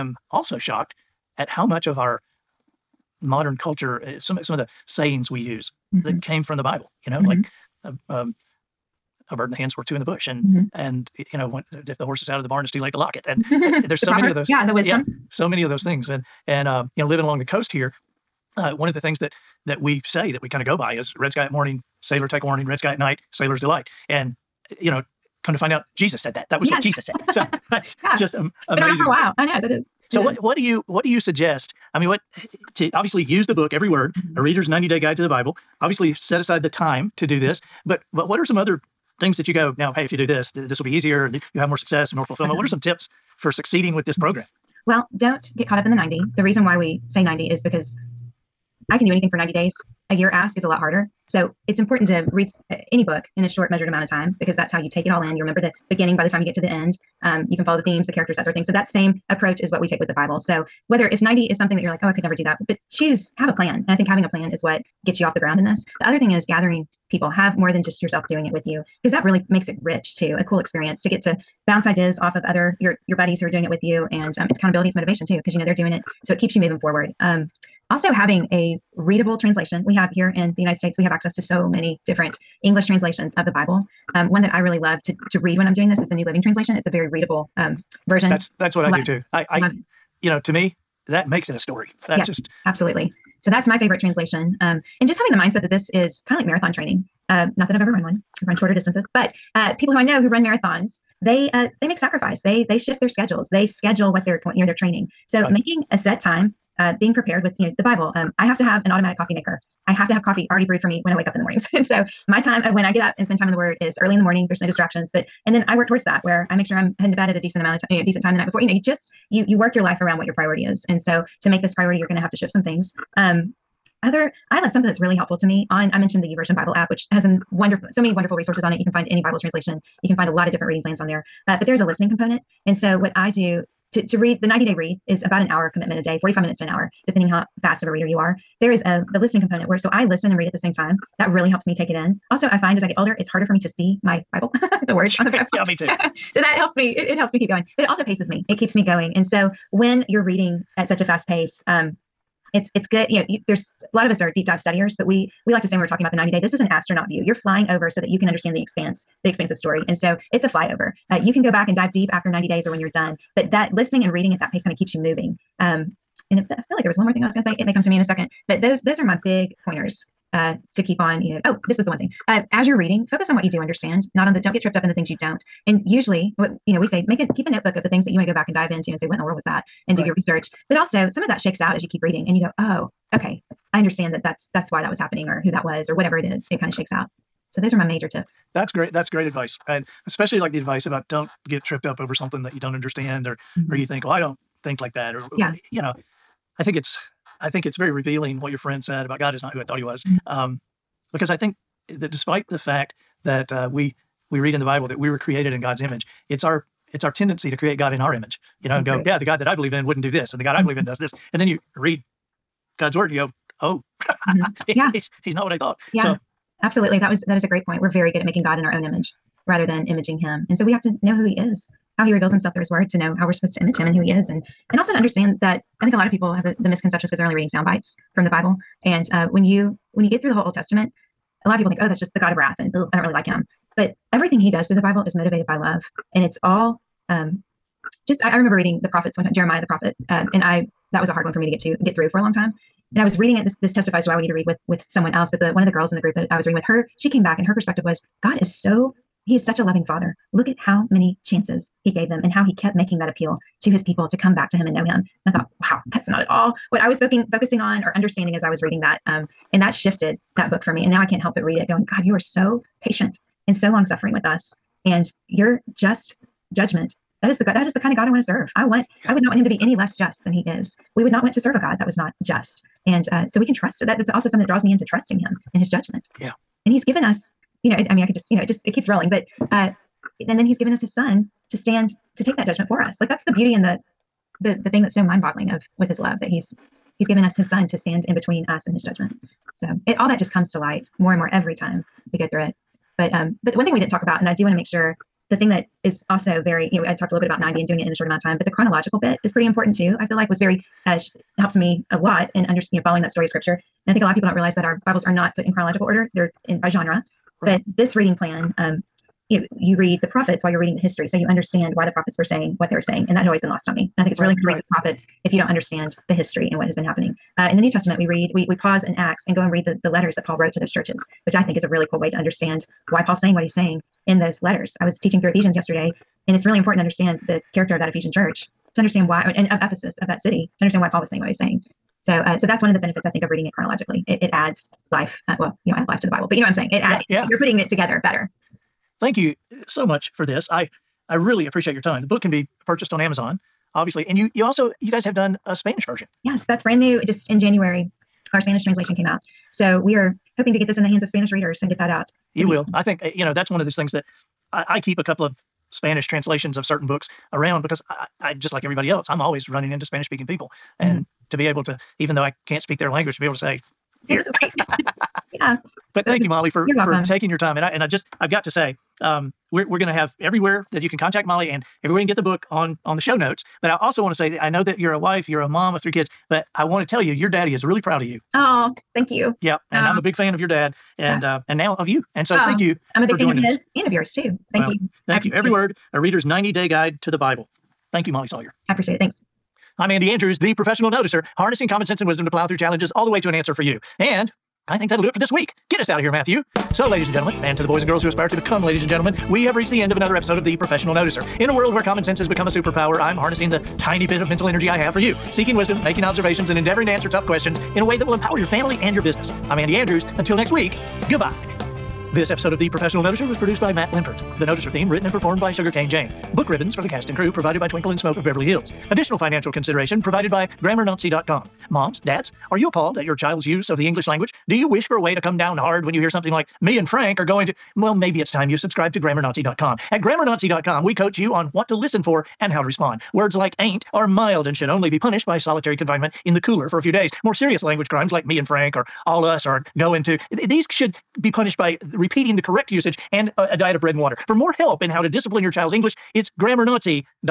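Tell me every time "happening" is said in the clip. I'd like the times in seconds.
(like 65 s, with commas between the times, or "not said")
184 s, 316 s.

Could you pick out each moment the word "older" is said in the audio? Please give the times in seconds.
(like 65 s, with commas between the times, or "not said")
142 s.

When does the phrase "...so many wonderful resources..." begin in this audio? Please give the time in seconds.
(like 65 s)
127 s.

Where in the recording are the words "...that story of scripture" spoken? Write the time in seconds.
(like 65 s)
303 s.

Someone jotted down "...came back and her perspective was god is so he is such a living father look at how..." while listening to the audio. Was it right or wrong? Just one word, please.
wrong.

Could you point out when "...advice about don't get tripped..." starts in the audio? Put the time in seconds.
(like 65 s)
190 s.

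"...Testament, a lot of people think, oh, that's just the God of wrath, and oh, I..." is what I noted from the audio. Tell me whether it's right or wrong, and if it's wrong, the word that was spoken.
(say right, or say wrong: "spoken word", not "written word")
right.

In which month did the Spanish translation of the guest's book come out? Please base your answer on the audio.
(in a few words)
January.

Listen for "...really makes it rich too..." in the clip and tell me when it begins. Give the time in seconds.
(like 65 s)
69 s.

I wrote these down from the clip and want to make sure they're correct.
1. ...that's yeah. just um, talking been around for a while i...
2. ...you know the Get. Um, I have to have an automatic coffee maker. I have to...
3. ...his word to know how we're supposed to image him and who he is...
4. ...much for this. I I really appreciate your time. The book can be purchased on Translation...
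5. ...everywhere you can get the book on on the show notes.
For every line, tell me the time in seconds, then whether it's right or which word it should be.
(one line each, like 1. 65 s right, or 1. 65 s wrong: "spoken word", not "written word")
1. 27 s wrong: "amazing", not "talking"
2. 107 s wrong: "Bible", not "Get"
3. 222 s right
4. 339 s wrong: "Amazon", not "Translation"
5. 371 s right.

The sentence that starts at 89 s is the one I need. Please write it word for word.
I I you know to me that makes it a story.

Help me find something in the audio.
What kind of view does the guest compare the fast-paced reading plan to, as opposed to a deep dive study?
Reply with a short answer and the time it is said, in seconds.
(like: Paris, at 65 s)
Astronaut view, at 156 s.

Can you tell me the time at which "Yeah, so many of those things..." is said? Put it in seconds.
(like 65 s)
15 s.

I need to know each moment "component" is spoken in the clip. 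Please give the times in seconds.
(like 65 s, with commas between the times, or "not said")
132 s, 139 s.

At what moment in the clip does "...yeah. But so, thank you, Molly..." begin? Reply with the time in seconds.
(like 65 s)
365 s.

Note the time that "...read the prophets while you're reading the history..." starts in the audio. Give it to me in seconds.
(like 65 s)
309 s.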